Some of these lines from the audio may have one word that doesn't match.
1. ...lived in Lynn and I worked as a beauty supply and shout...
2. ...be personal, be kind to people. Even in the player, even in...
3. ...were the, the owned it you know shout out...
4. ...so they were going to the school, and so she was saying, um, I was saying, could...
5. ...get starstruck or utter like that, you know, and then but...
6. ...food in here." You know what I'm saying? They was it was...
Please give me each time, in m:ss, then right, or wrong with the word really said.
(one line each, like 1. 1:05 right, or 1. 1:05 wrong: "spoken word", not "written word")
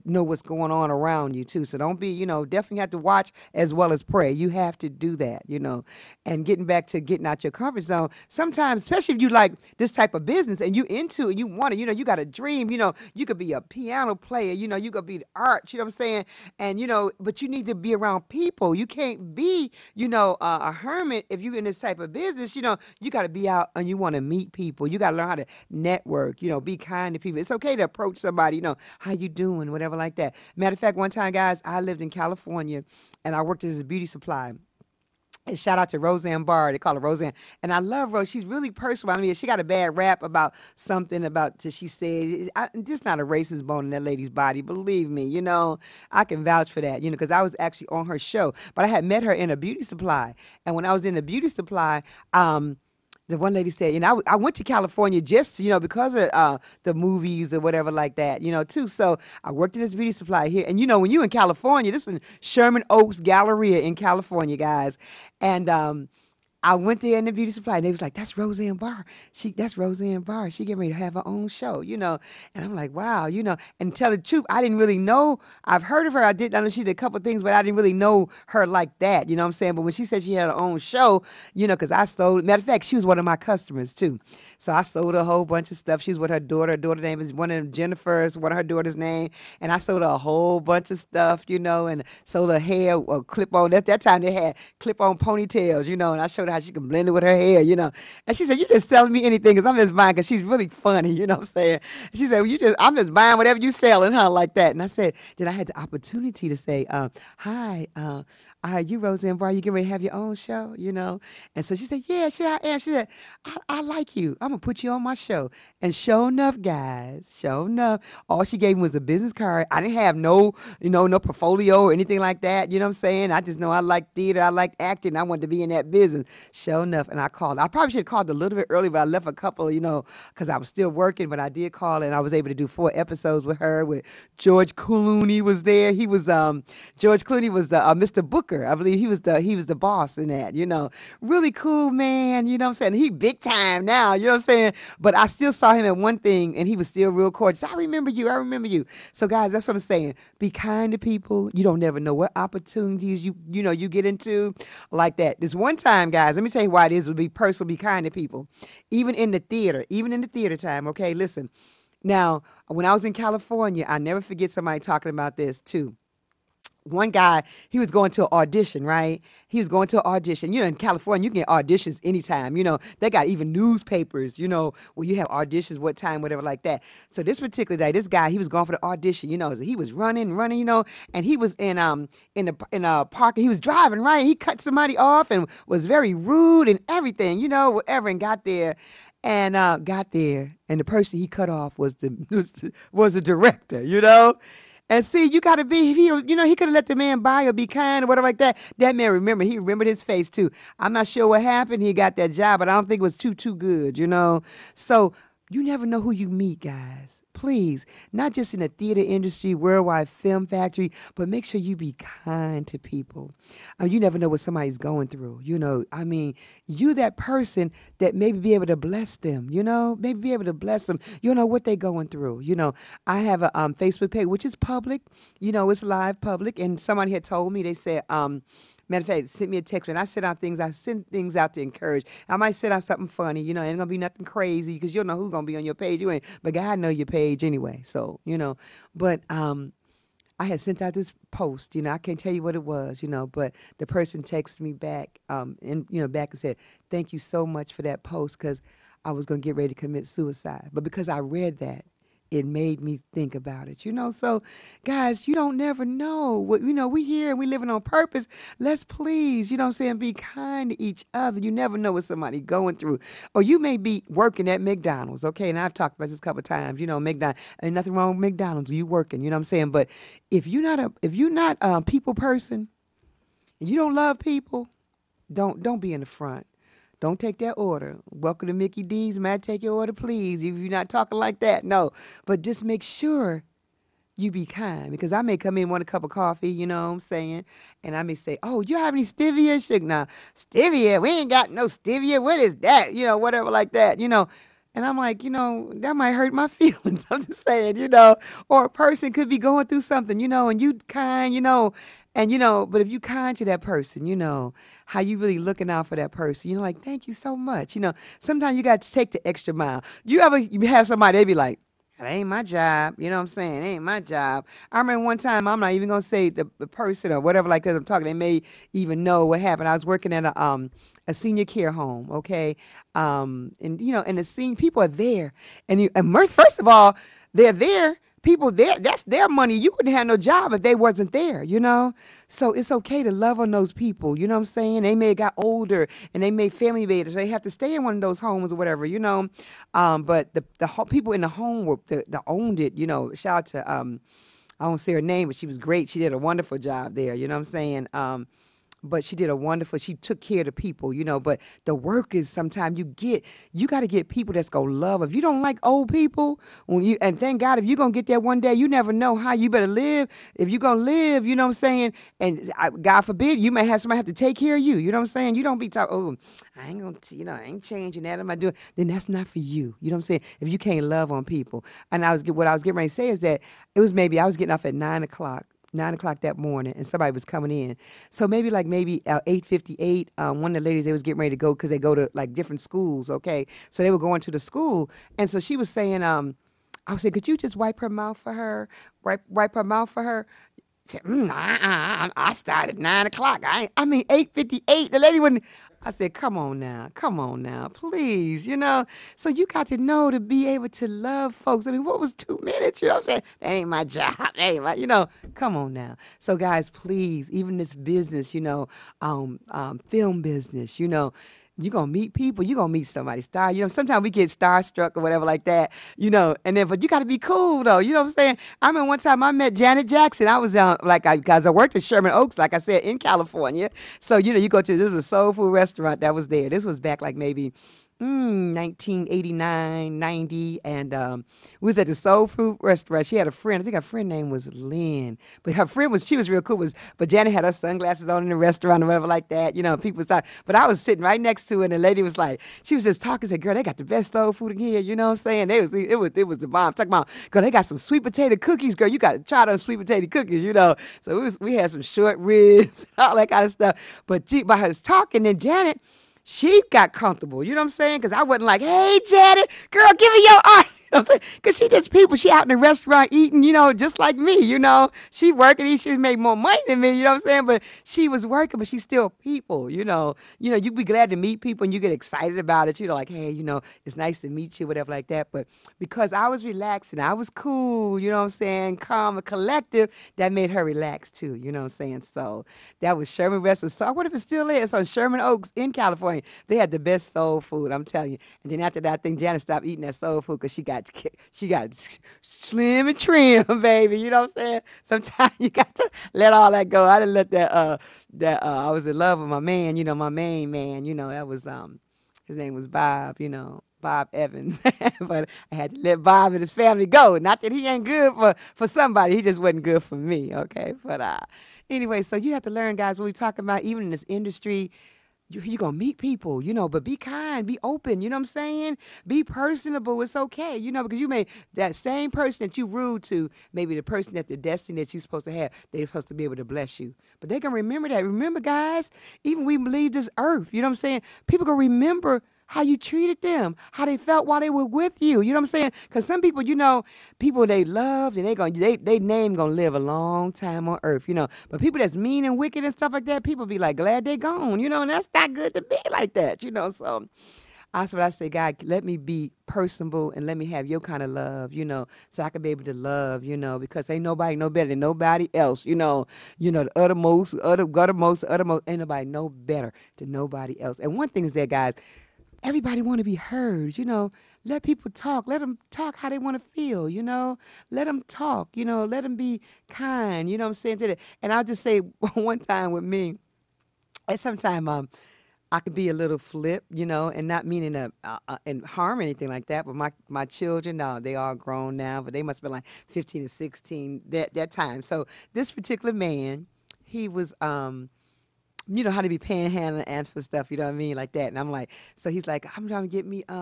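1. 0:31 wrong: "California", not "Lynn"
2. 2:37 wrong: "theater", not "player"
3. 5:41 right
4. 6:23 right
5. 6:54 wrong: "whatever", not "utter"
6. 7:24 right.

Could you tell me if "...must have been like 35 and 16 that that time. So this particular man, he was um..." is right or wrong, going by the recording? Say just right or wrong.
wrong.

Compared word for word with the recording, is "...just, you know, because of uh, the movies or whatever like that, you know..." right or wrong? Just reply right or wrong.
right.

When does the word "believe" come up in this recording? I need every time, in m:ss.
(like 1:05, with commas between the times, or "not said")
0:44, 2:18.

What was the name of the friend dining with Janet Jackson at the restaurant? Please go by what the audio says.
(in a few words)
Lynn.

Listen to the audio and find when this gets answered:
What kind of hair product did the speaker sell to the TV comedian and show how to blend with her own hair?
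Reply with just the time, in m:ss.
1:34.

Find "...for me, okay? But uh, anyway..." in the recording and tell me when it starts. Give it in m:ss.
8:29.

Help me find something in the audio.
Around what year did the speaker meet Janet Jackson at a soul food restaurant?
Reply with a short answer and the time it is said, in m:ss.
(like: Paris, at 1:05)
1989, at 7:08.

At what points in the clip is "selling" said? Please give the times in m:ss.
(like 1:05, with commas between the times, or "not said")
1:38, 1:43.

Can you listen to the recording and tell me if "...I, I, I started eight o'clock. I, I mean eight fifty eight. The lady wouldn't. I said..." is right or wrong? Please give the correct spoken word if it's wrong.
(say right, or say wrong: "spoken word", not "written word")
wrong: "nine", not "eight".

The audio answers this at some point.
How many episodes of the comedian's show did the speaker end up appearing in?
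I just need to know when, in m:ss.
2:12.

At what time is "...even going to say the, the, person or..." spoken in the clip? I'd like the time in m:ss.
5:15.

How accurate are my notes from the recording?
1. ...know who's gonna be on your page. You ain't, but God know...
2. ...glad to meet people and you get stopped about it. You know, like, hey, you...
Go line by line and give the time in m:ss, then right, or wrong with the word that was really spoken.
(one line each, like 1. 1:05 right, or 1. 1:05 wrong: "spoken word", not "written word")
1. 3:55 right
2. 7:50 wrong: "excited", not "stopped".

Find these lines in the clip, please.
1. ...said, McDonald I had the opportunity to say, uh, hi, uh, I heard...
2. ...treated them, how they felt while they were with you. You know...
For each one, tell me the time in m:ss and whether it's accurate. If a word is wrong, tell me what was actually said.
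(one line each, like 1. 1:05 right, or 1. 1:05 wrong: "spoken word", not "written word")
1. 1:44 wrong: "Then", not "McDonald"
2. 8:52 right.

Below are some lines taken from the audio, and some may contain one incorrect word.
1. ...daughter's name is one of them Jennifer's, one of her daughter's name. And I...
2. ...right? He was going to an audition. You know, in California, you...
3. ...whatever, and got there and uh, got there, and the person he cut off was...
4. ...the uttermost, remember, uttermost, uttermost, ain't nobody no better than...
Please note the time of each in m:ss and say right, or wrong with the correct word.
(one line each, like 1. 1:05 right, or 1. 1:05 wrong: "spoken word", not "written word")
1. 1:26 right
2. 2:48 right
3. 3:07 right
4. 9:16 wrong: "utter", not "remember".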